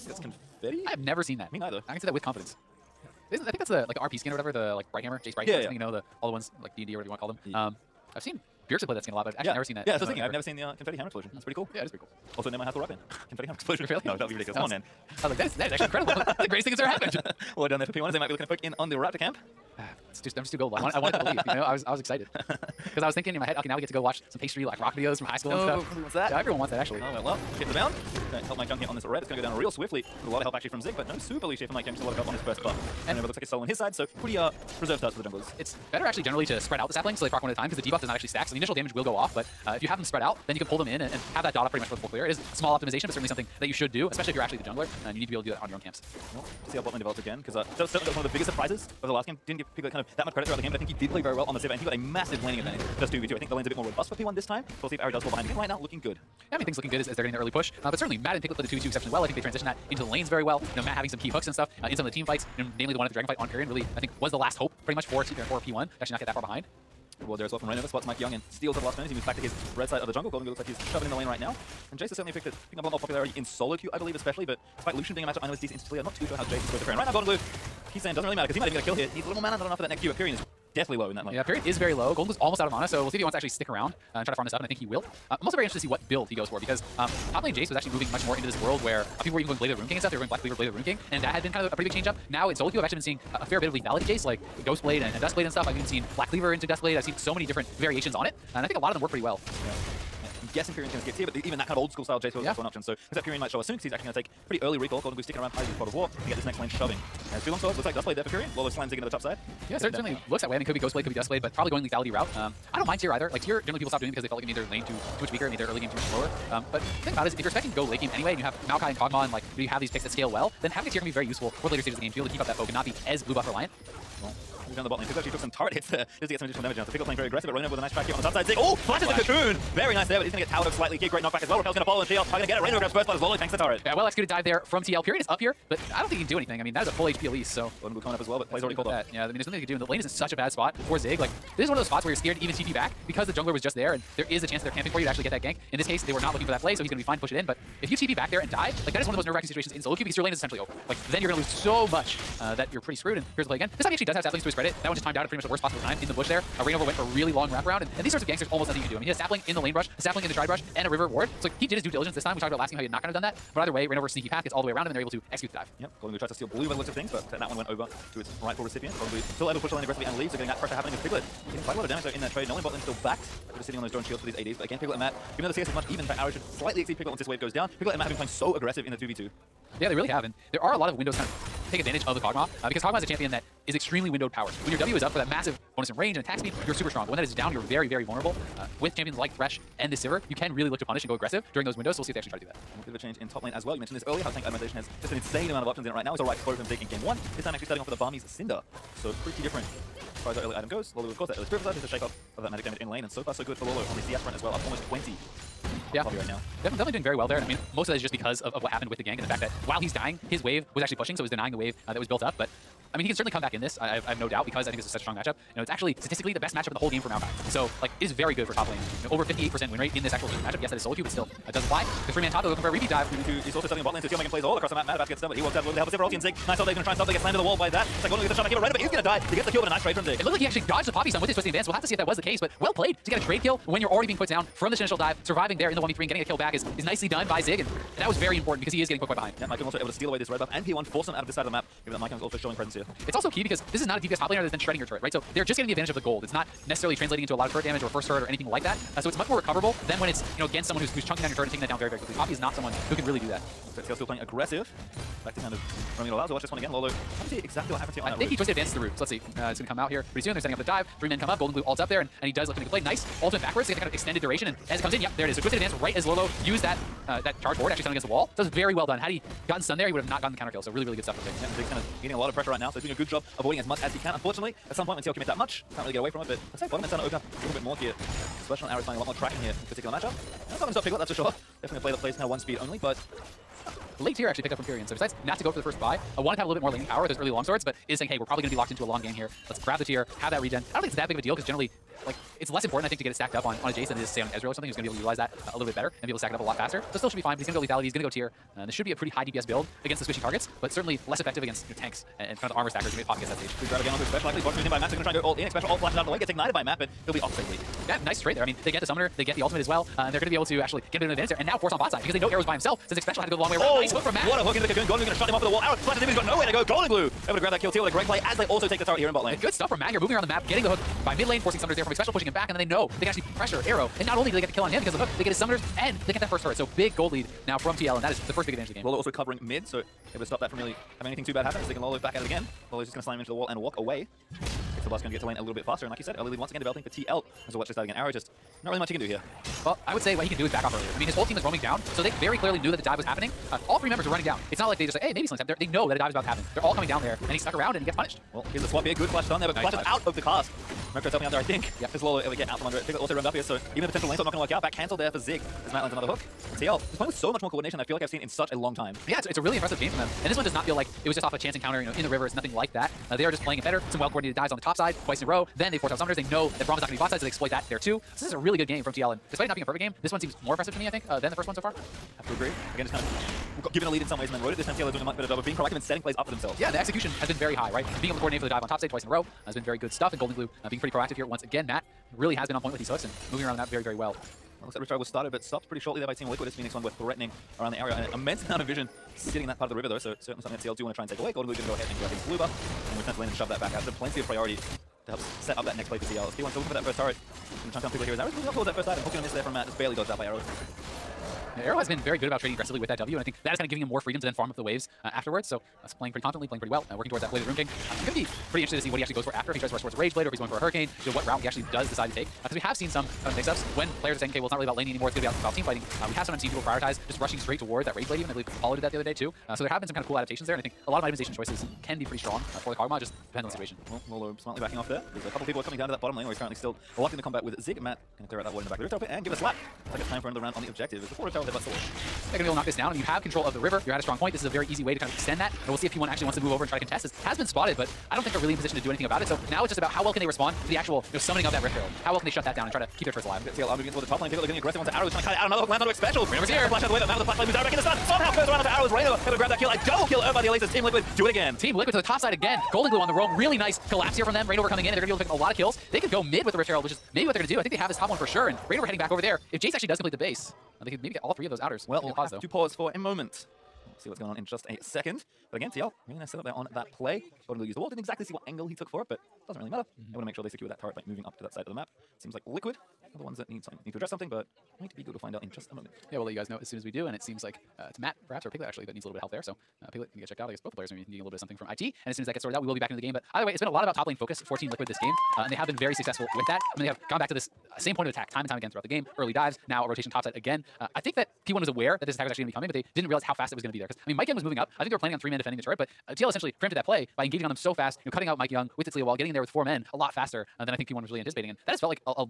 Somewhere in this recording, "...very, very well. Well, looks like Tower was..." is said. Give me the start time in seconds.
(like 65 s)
383 s.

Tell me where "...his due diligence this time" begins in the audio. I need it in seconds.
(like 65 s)
161 s.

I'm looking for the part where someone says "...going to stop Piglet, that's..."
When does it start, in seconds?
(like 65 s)
280 s.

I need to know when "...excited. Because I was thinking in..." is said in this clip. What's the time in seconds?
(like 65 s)
21 s.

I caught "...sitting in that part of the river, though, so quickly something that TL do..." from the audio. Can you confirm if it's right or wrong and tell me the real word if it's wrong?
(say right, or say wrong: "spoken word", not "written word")
wrong: "certainly", not "quickly".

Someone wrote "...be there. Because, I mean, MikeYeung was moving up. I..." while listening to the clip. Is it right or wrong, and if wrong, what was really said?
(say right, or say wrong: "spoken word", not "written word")
right.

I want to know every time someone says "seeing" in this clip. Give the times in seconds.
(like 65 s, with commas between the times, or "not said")
93 s.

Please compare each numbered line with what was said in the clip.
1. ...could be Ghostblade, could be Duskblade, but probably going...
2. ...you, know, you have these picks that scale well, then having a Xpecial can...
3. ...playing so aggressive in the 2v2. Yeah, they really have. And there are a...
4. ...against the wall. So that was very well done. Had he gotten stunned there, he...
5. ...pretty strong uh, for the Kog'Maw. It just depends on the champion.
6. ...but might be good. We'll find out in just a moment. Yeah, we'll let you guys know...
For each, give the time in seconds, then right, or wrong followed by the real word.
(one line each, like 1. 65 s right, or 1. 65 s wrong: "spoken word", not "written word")
1. 110 s right
2. 119 s wrong: "Tear", not "Xpecial"
3. 178 s right
4. 267 s right
5. 422 s wrong: "situation", not "champion"
6. 474 s right.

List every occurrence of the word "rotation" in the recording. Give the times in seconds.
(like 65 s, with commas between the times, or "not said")
489 s.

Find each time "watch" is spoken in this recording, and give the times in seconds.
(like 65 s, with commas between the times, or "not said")
24 s, 256 s, 337 s.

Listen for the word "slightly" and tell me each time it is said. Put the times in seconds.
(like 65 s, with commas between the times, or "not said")
130 s, 176 s.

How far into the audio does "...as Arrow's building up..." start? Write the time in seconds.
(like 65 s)
398 s.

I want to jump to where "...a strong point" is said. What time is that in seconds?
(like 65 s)
433 s.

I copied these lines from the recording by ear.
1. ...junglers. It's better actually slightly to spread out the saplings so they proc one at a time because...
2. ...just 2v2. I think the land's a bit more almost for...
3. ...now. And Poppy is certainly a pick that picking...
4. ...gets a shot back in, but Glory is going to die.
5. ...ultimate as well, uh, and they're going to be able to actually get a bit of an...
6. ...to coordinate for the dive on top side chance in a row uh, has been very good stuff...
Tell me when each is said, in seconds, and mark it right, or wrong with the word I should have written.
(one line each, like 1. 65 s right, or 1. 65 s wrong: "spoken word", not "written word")
1. 35 s wrong: "generally", not "slightly"
2. 52 s wrong: "robust", not "almost"
3. 71 s wrong: "Jace", not "Poppy"
4. 228 s wrong: "Reignover", not "Glory"
5. 309 s right
6. 378 s wrong: "twice", not "chance".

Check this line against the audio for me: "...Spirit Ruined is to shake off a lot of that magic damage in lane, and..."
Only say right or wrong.
wrong.